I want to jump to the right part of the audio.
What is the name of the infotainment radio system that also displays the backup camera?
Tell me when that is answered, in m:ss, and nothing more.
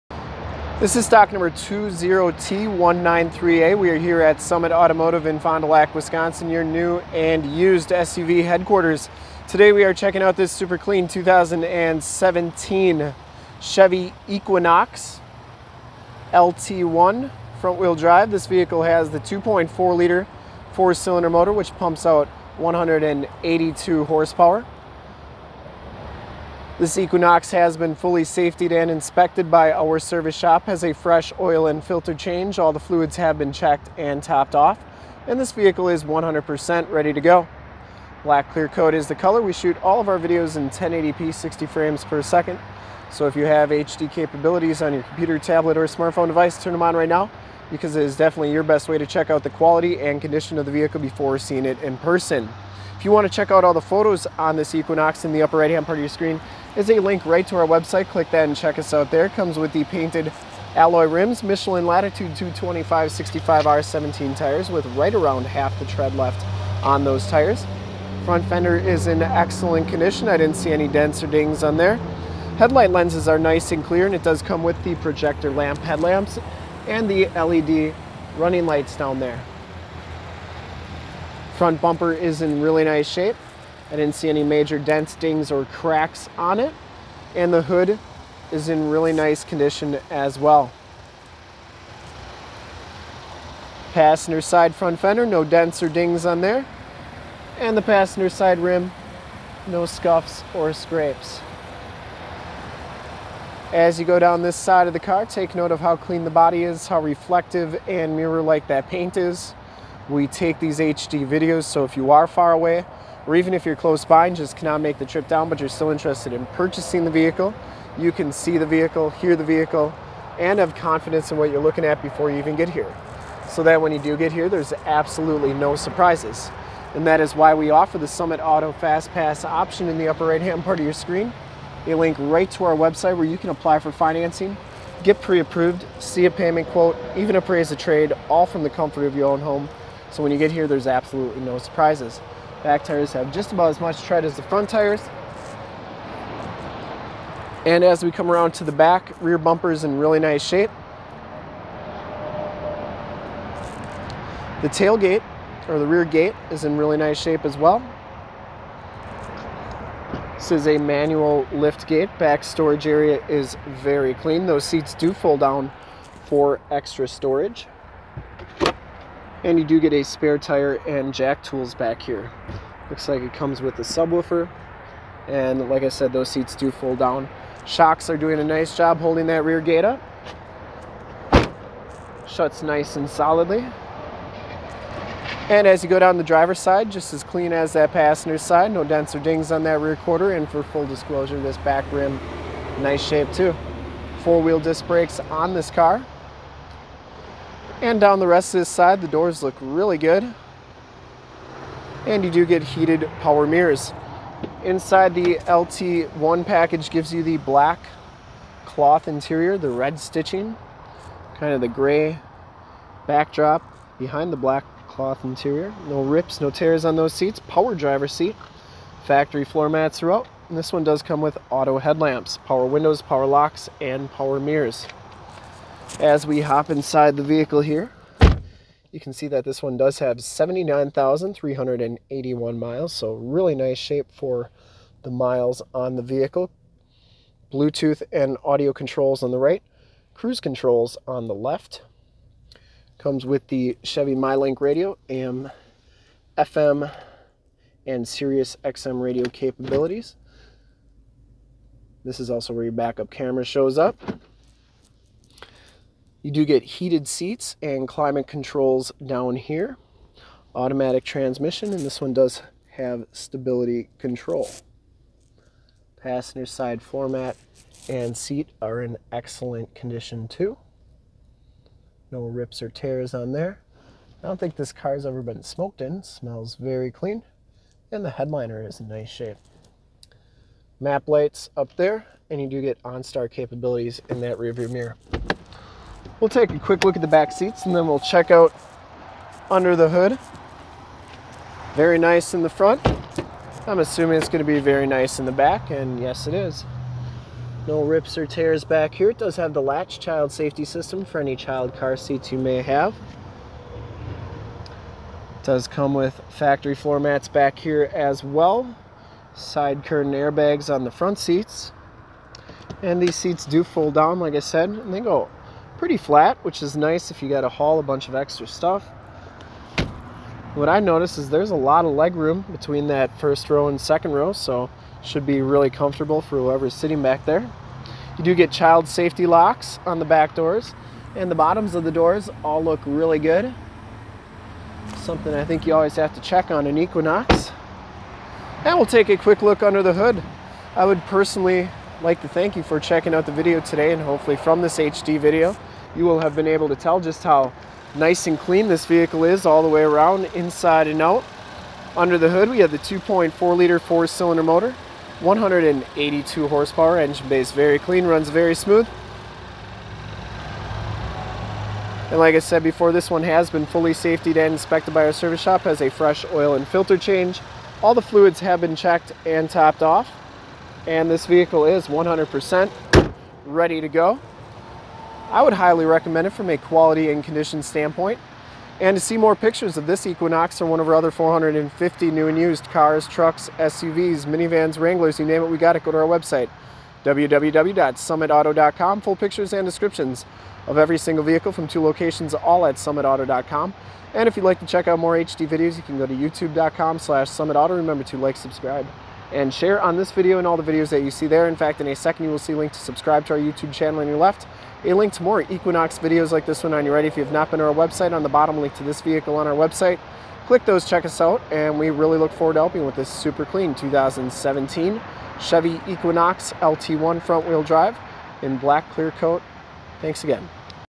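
4:03.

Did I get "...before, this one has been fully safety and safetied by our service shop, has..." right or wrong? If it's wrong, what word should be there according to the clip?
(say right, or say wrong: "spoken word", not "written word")
wrong: "inspected", not "safetied".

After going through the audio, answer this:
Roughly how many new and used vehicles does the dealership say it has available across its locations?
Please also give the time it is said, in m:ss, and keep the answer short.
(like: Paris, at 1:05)
450, at 6:21.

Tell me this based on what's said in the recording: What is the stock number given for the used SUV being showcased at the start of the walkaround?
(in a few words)
20T193A.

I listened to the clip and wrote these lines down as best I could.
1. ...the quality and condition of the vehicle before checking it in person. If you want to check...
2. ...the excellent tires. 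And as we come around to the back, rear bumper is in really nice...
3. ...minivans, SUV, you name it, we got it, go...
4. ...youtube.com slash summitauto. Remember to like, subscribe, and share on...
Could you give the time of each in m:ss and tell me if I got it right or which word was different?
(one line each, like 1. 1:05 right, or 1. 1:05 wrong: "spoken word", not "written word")
1. 0:49 wrong: "seeing", not "checking"
2. 2:24 wrong: "front", not "excellent"
3. 6:24 wrong: "Wranglers", not "SUV"
4. 6:36 right.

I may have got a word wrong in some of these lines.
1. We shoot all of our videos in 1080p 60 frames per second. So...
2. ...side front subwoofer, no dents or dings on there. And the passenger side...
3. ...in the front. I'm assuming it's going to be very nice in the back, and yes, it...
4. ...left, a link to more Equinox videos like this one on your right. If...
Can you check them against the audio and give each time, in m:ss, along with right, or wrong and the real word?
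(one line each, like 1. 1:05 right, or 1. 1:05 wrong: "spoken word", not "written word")
1. 0:39 right
2. 1:34 wrong: "fender", not "subwoofer"
3. 4:52 right
4. 6:44 right.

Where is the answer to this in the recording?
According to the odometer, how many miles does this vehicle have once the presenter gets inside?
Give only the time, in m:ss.
3:50.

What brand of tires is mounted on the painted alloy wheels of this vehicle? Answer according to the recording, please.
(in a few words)
Michelin Latitude.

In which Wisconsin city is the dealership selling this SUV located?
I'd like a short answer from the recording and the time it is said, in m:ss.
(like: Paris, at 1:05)
Fond du Lac, at 0:05.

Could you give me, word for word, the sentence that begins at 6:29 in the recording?
Full pictures and descriptions of every single vehicle from two locations, all at summitauto.com.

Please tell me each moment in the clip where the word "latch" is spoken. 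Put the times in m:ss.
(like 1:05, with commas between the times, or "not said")
4:59.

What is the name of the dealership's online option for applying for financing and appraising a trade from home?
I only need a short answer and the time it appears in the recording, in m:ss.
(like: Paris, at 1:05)
Summit Auto Fast Pass, at 2:08.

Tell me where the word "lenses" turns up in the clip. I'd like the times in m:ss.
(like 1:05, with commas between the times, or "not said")
1:12.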